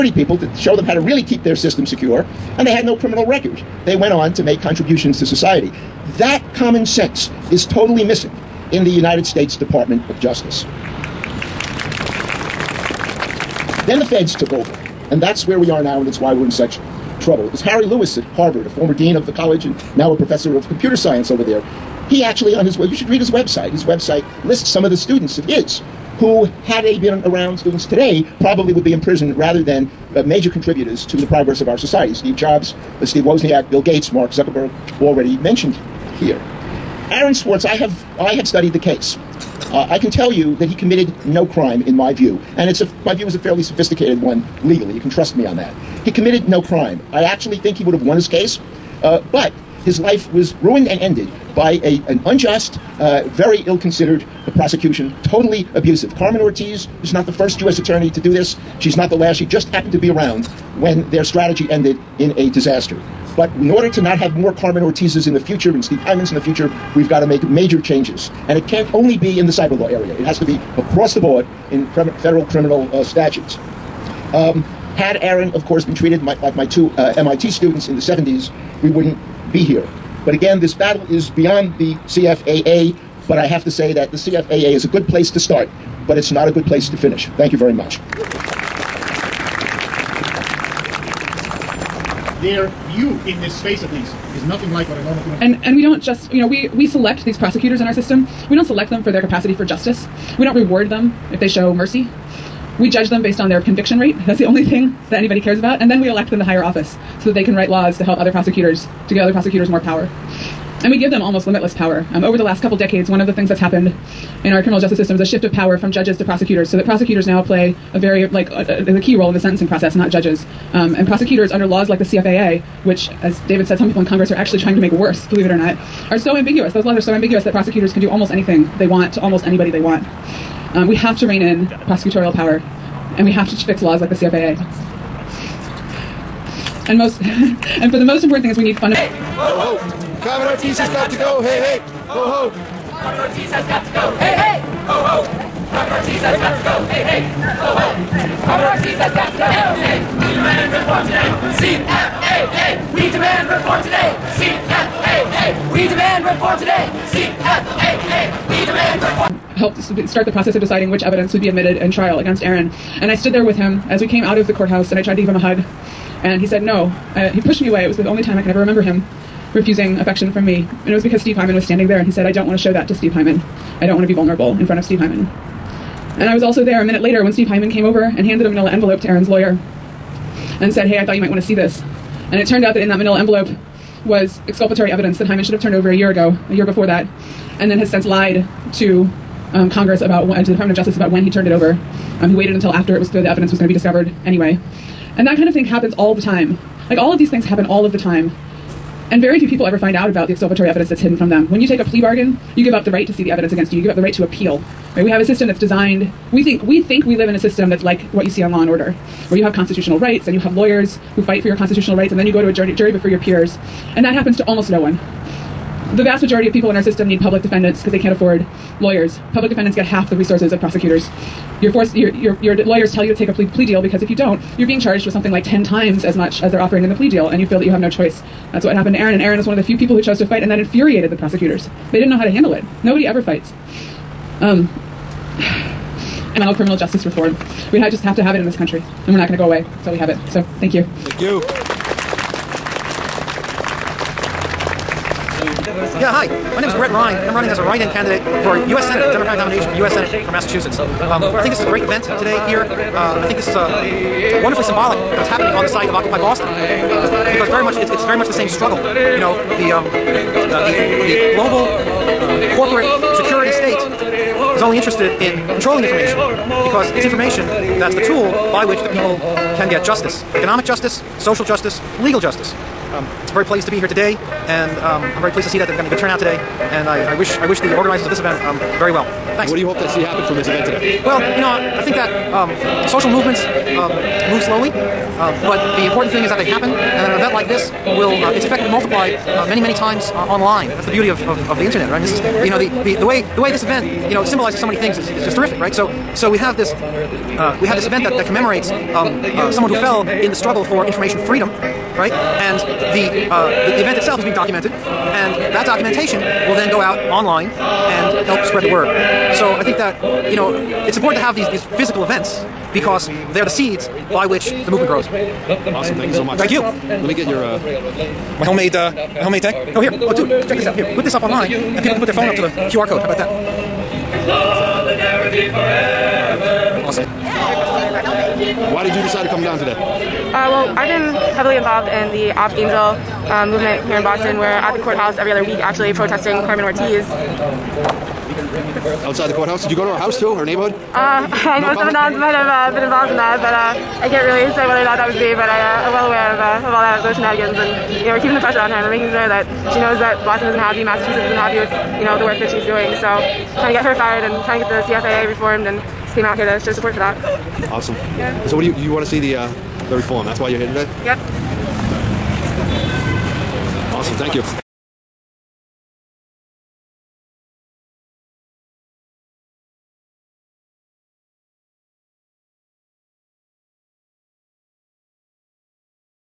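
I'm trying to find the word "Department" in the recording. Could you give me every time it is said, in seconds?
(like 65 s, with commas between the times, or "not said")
9 s, 190 s.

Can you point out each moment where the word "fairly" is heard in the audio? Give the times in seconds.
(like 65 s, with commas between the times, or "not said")
43 s.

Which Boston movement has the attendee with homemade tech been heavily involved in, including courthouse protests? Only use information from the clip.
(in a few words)
Op Angel.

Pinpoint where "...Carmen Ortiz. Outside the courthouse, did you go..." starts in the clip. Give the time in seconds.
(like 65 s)
336 s.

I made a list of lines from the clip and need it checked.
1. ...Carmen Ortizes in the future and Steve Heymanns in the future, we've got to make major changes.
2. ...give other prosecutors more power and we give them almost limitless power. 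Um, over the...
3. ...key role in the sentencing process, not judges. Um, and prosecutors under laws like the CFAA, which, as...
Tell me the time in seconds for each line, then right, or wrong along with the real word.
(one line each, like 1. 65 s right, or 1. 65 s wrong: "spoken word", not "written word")
1. 64 s right
2. 109 s right
3. 119 s right.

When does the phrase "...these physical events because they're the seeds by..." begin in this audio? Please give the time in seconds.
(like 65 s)
311 s.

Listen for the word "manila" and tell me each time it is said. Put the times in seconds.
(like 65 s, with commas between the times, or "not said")
178 s, 182 s.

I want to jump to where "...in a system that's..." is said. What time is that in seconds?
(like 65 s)
207 s.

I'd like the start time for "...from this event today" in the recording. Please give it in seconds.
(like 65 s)
280 s.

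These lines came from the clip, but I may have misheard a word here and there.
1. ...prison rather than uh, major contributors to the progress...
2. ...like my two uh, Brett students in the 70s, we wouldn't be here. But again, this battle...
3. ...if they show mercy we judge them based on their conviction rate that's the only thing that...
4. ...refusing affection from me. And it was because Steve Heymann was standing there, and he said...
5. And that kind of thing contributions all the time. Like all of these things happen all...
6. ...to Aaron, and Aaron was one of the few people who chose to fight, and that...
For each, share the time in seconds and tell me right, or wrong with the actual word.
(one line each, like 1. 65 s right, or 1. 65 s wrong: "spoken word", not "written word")
1. 29 s right
2. 76 s wrong: "MIT", not "Brett"
3. 101 s right
4. 169 s right
5. 195 s wrong: "happens", not "contributions"
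6. 228 s right.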